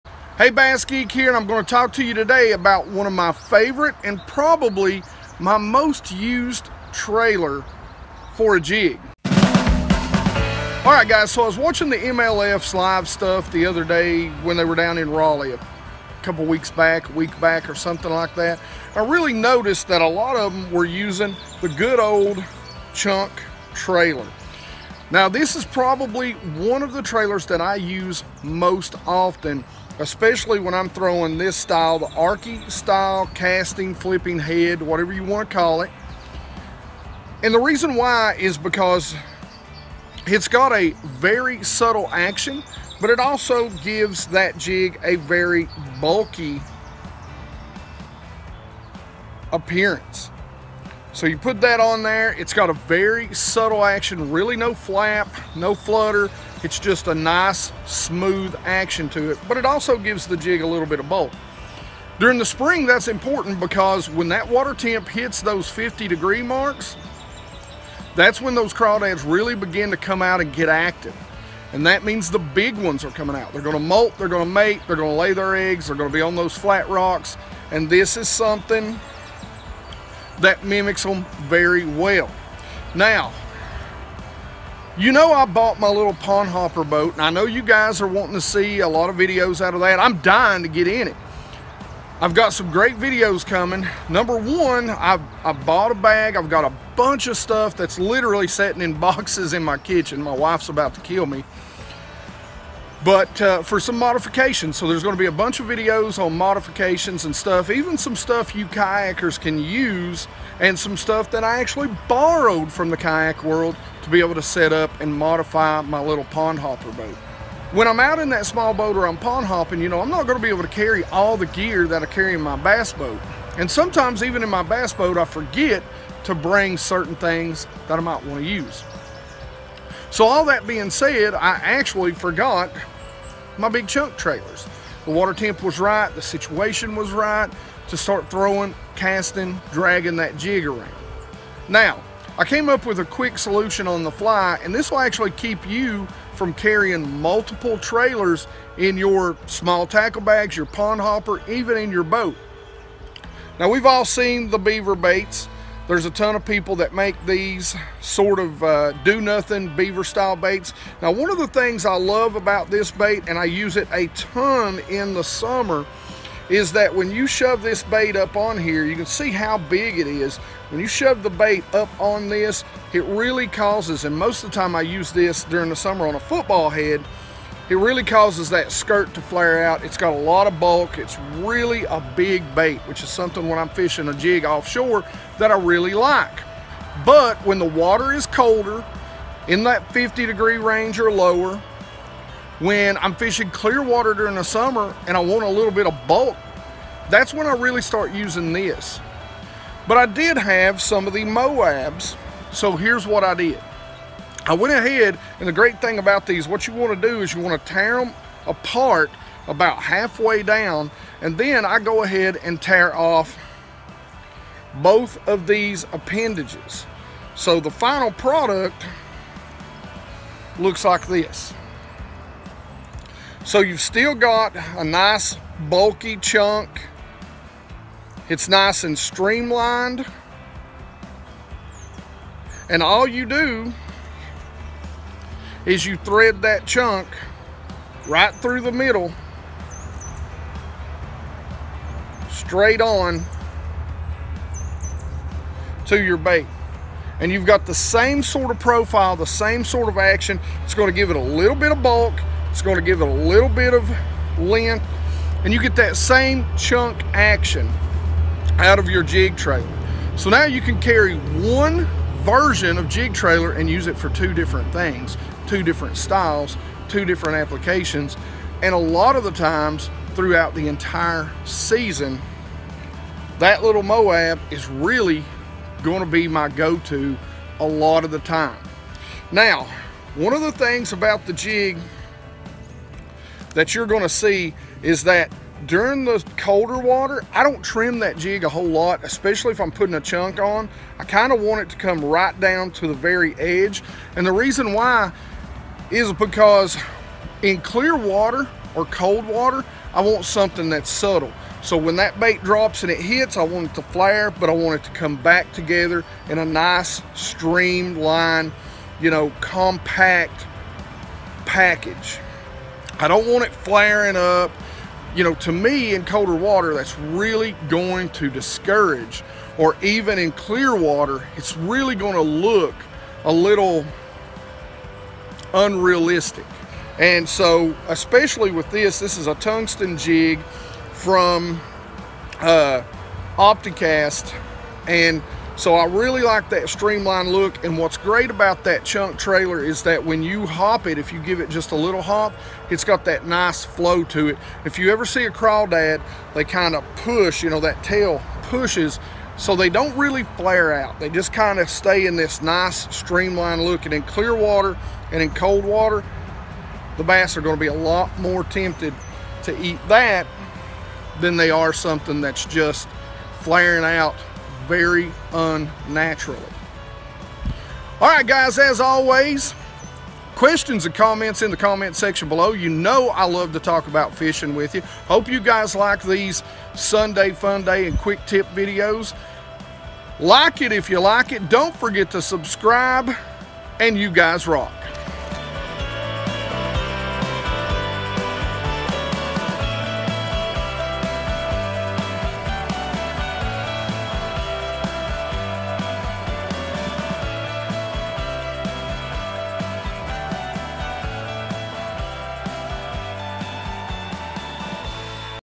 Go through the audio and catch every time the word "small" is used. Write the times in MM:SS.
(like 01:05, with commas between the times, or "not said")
01:58, 02:29.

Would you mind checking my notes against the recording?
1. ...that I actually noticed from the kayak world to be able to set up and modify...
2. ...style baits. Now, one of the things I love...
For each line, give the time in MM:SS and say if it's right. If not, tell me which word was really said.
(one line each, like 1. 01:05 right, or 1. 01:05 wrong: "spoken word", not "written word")
1. 01:51 wrong: "borrowed", not "noticed"
2. 02:40 right.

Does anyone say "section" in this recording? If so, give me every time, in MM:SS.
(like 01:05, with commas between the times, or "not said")
06:11.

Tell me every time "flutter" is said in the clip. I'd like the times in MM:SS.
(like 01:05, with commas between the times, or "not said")
00:55.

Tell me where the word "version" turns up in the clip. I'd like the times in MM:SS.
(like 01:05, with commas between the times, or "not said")
04:22.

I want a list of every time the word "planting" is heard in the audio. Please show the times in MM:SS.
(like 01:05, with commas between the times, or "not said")
not said.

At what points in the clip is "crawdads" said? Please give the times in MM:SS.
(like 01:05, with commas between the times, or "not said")
01:08, 05:45.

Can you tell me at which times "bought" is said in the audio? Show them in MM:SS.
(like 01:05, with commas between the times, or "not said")
01:25, 01:35.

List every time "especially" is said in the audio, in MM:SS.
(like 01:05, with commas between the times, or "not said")
00:30, 04:49, 05:27.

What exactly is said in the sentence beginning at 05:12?
I don't want it flaring up.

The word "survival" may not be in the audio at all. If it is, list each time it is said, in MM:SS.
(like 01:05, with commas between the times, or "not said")
not said.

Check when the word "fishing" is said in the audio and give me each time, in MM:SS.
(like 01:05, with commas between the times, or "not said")
03:03, 03:13, 06:14.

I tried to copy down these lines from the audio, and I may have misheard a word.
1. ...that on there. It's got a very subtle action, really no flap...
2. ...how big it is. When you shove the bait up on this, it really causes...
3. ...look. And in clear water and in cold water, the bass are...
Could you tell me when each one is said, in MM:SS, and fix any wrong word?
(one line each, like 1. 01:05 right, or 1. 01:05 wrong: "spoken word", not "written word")
1. 00:51 right
2. 02:49 right
3. 05:53 right.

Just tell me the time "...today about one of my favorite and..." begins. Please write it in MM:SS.
00:02.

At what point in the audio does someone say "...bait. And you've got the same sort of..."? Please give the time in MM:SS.
04:06.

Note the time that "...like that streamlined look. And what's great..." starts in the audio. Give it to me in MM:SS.
05:36.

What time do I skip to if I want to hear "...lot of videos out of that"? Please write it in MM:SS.
01:28.